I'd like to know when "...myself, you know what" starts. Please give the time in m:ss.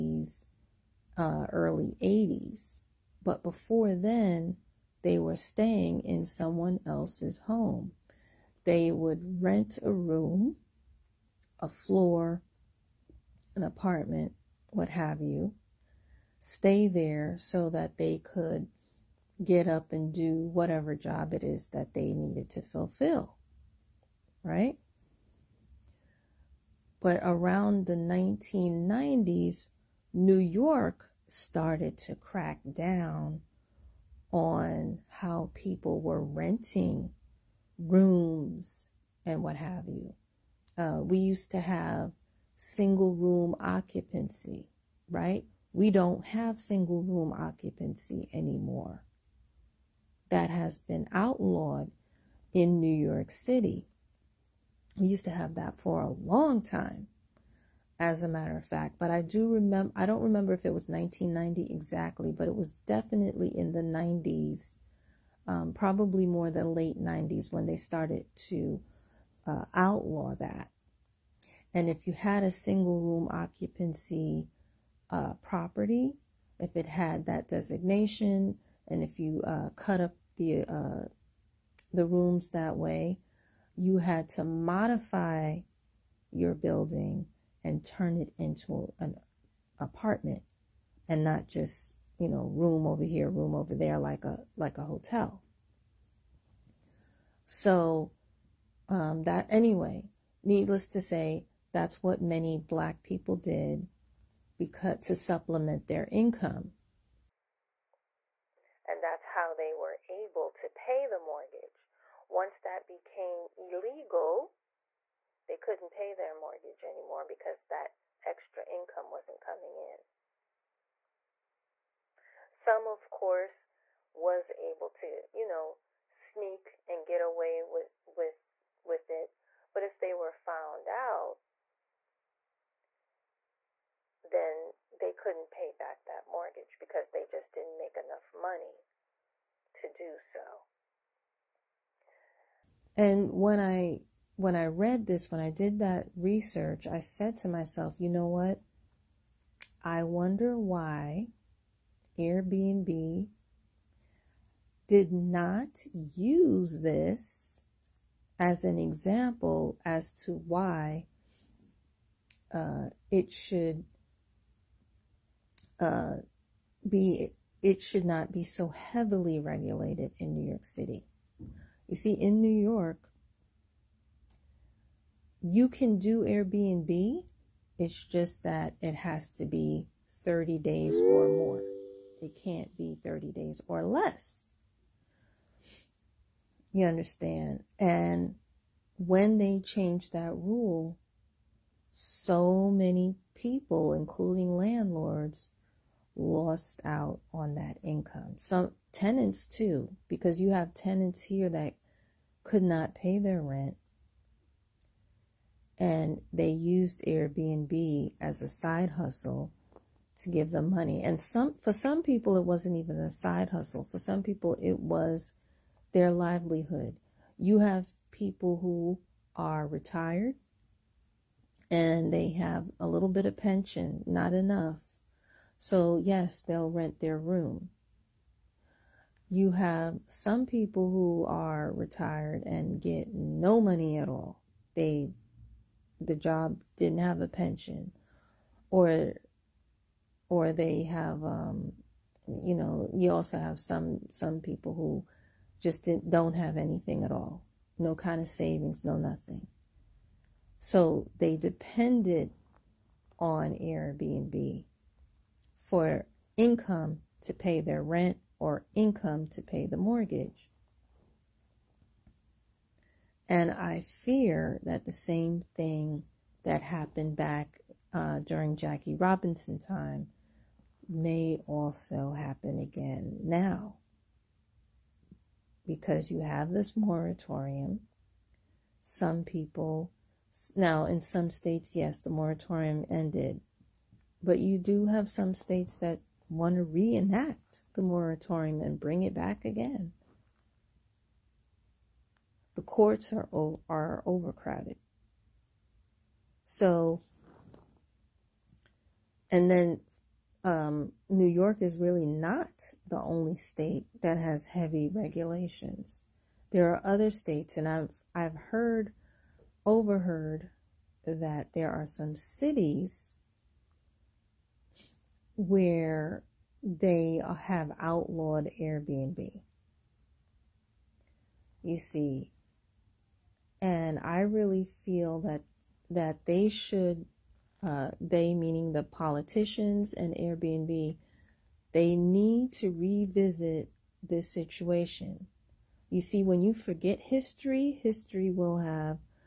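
2:27.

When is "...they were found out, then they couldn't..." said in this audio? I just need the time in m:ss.
2:09.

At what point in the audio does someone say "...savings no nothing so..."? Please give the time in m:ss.
4:08.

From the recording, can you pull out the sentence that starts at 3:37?
You have people who are retired and they have a little bit of pension, not enough.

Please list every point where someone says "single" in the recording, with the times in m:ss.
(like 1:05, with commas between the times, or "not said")
0:42, 0:46, 1:12.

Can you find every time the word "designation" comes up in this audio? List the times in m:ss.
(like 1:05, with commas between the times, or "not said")
1:17.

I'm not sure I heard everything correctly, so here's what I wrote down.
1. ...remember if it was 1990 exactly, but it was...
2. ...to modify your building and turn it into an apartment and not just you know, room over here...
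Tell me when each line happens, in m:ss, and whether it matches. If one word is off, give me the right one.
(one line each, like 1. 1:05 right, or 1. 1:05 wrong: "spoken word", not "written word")
1. 1:00 right
2. 1:24 right.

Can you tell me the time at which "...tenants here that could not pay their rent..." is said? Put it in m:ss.
3:20.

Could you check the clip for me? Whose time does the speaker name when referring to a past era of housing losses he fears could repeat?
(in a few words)
Jackie Robinson.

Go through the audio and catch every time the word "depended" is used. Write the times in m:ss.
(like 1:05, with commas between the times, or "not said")
4:11.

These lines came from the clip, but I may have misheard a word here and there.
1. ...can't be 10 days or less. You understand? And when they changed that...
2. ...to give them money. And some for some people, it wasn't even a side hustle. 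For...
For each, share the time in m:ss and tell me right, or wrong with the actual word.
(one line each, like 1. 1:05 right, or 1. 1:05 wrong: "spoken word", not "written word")
1. 3:02 wrong: "30", not "10"
2. 3:30 right.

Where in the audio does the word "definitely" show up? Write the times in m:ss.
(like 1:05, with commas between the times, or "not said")
1:02.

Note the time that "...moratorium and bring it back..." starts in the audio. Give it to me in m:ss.
4:47.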